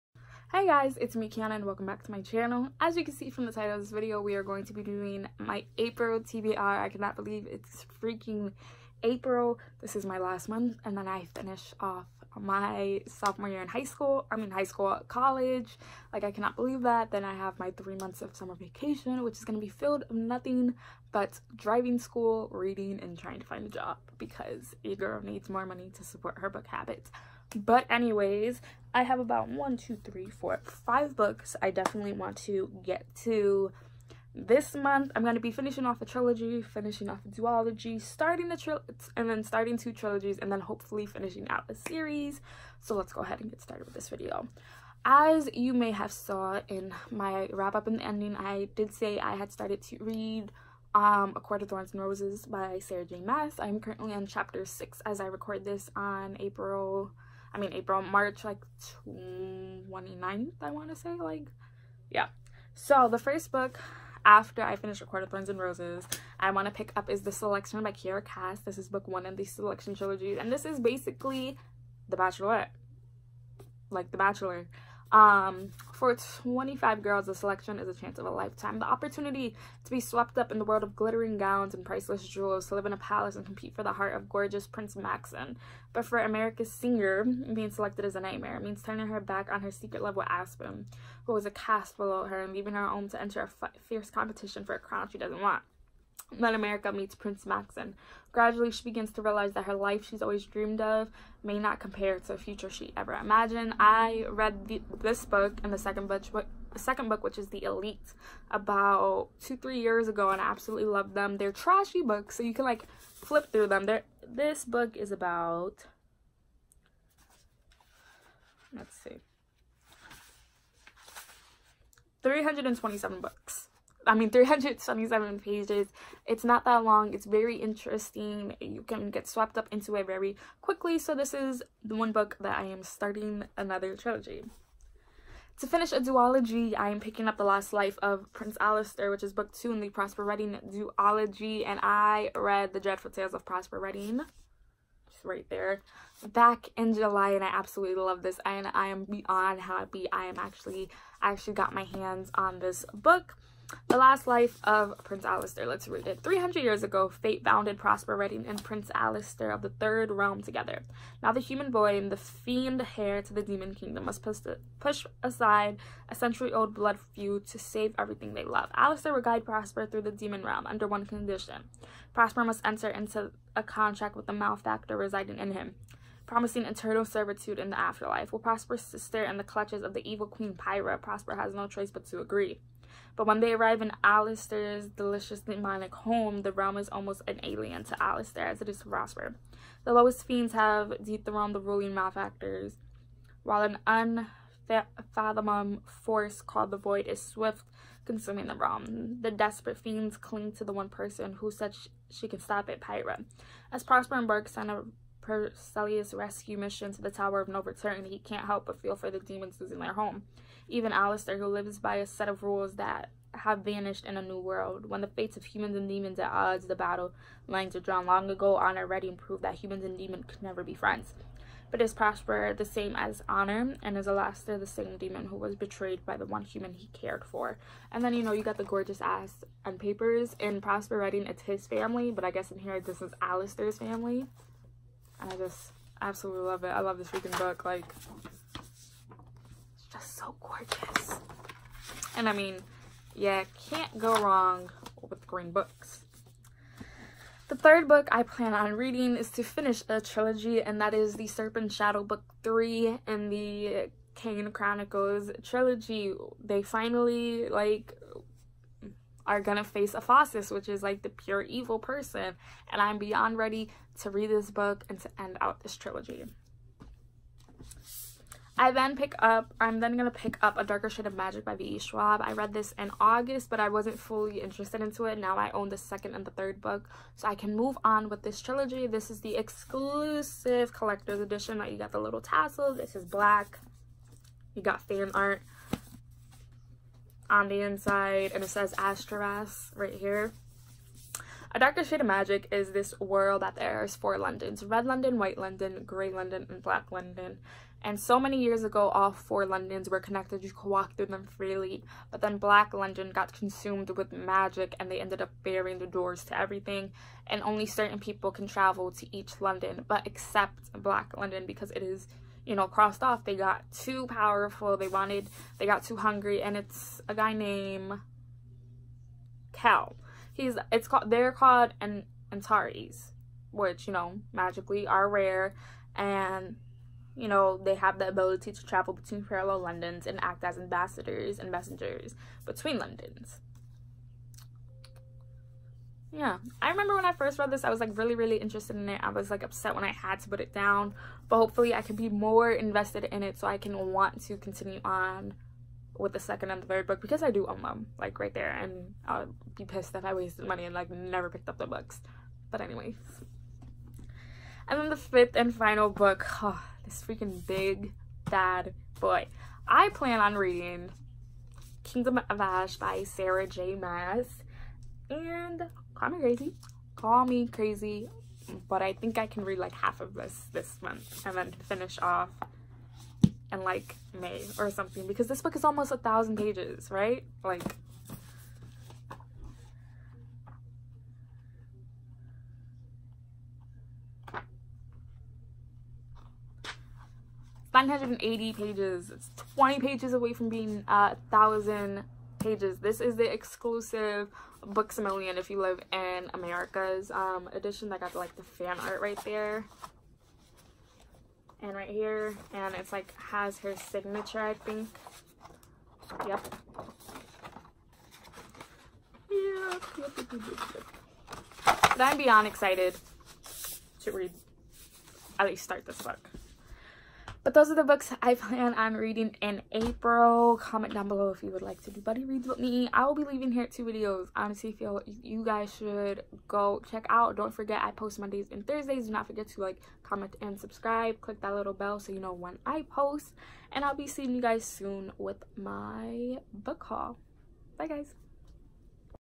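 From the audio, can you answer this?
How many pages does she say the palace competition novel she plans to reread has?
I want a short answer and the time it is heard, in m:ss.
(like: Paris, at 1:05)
327, at 2:04.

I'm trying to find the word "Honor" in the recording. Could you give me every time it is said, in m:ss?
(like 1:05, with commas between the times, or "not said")
3:38, 3:43.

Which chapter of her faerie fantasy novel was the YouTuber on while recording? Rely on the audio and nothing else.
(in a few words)
6.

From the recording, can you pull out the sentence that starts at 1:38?
Gradually, she begins to realize that her life she's always dreamed of may not compare to a future she ever imagined.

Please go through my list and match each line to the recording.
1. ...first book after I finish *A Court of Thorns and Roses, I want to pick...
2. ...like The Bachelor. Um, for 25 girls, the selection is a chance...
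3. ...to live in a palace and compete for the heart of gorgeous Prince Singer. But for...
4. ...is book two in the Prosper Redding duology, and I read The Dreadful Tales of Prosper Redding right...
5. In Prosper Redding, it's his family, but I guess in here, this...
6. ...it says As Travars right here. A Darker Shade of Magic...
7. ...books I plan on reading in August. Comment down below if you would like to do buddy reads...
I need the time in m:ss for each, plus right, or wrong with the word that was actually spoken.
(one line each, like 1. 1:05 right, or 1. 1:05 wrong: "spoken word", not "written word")
1. 1:03 right
2. 1:13 right
3. 1:22 wrong: "Maxon", not "Singer"
4. 2:19 right
5. 3:50 right
6. 4:48 right
7. 6:57 wrong: "April", not "August".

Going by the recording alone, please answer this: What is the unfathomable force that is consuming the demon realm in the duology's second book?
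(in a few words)
the Void.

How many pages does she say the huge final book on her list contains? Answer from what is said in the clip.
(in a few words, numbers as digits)
980.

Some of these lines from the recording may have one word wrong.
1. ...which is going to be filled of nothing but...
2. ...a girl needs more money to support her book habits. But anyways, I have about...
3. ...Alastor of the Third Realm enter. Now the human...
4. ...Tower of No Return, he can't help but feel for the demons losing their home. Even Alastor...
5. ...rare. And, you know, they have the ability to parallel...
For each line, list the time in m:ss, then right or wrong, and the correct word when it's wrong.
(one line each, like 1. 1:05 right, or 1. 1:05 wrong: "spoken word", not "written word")
1. 0:19 right
2. 0:24 right
3. 2:38 wrong: "together", not "enter"
4. 3:27 right
5. 5:25 wrong: "travel", not "parallel".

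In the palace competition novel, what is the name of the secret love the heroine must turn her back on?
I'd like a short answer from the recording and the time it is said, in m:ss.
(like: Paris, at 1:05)
Aspen, at 1:30.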